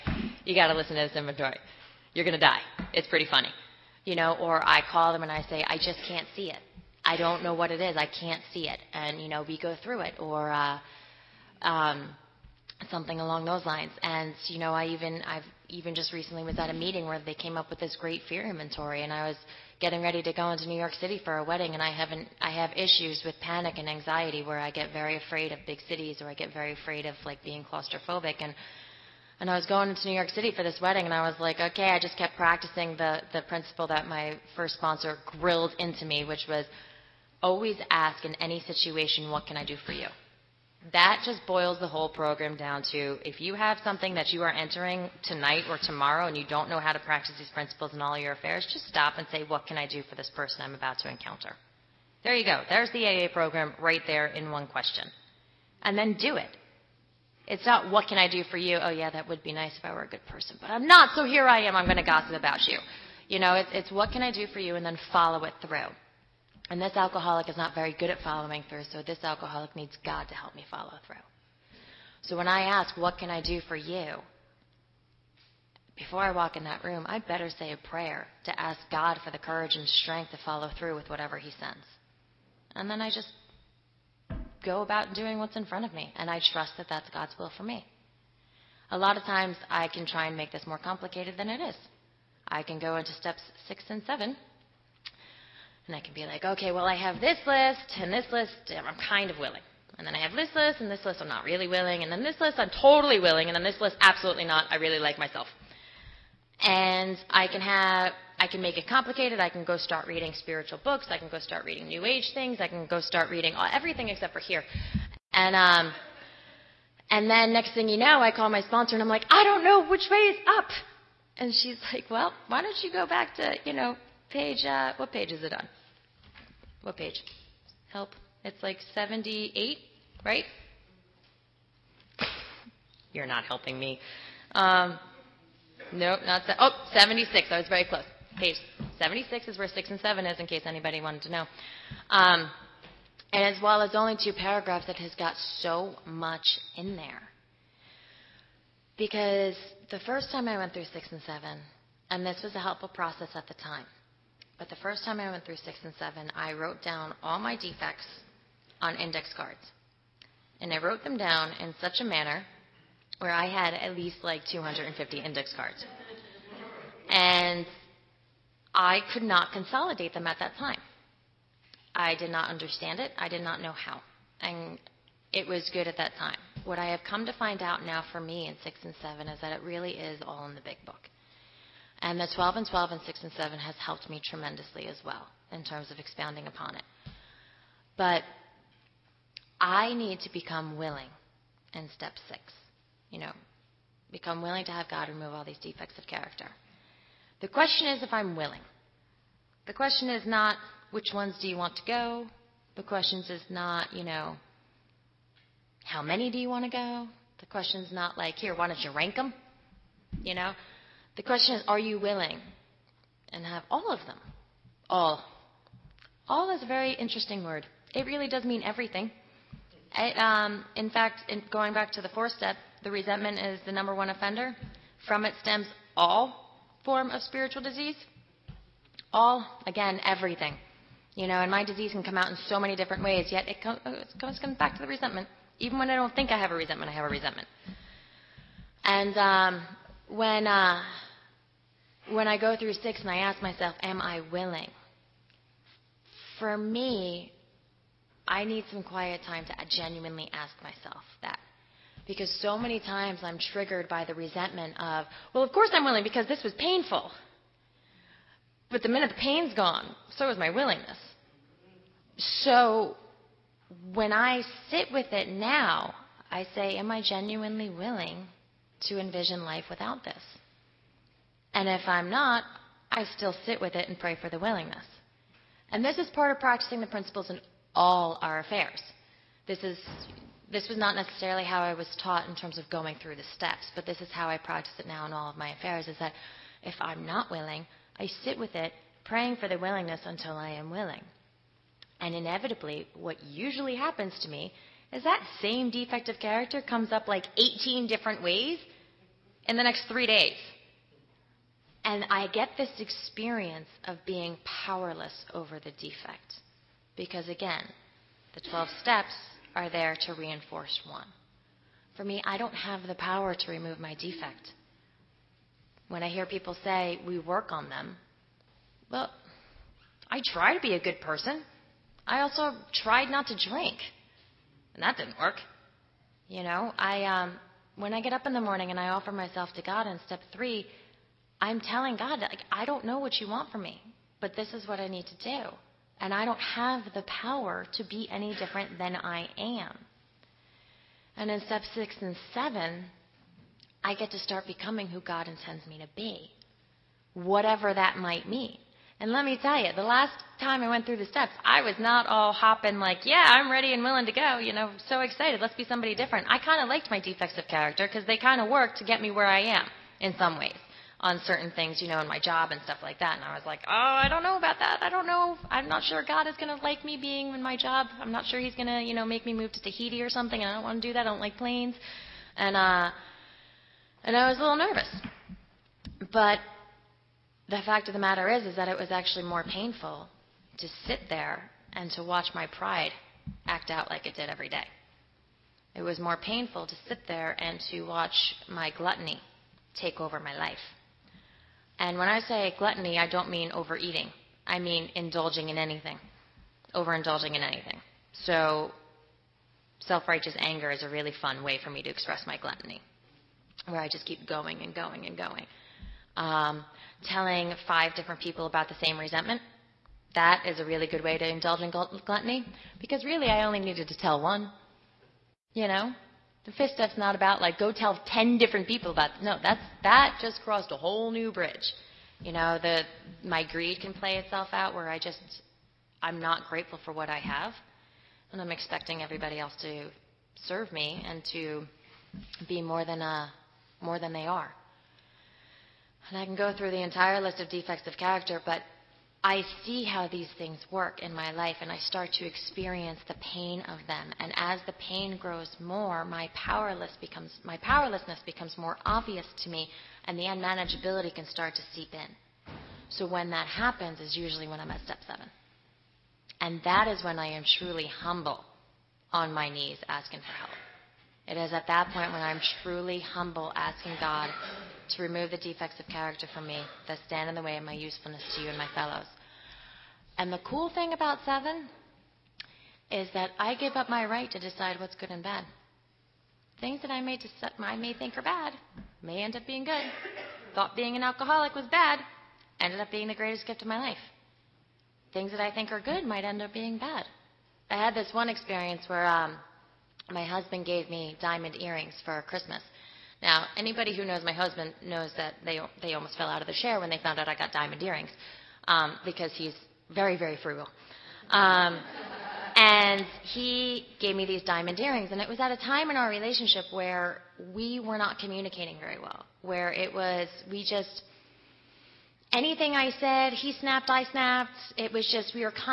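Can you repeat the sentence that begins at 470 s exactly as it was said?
And the cool thing about seven is that I give up my right to decide what's good and bad.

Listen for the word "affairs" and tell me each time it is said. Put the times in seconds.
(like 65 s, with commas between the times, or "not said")
48 s, 278 s, 285 s.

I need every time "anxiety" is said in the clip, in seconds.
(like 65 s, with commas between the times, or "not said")
23 s.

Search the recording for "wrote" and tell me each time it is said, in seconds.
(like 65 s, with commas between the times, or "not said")
156 s, 160 s.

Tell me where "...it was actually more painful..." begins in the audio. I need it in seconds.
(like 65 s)
378 s.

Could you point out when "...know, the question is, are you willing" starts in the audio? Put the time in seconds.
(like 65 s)
210 s.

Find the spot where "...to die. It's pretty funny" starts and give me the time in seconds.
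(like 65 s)
2 s.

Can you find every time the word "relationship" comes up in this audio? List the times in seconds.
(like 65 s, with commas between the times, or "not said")
506 s.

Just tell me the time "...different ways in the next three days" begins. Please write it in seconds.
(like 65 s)
297 s.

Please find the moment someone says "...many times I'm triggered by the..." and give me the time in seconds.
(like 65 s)
252 s.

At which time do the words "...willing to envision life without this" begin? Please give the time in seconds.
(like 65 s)
267 s.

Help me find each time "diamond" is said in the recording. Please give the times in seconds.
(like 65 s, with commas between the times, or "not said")
491 s, 497 s, 504 s.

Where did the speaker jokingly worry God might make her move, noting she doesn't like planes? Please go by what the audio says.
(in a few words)
Tahiti.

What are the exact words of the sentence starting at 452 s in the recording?
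So when that happens is usually when I'm at step 7.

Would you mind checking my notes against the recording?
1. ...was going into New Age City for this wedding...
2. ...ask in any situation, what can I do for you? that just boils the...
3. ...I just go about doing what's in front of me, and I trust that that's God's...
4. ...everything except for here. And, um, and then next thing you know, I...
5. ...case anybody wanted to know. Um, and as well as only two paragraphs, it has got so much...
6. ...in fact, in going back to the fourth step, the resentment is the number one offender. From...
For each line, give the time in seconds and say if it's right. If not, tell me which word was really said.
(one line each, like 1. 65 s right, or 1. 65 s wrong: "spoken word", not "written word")
1. 29 s wrong: "York", not "Age"
2. 37 s right
3. 83 s right
4. 113 s right
5. 140 s right
6. 220 s right.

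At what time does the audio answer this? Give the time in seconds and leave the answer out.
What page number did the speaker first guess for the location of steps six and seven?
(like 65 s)
128 s.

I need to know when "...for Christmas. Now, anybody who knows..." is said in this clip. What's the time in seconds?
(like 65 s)
492 s.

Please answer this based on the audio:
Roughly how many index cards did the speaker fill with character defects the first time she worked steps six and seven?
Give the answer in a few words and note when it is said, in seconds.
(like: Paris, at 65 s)
250, at 164 s.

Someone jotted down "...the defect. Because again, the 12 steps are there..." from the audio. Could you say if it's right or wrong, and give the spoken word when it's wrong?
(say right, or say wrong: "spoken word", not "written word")
right.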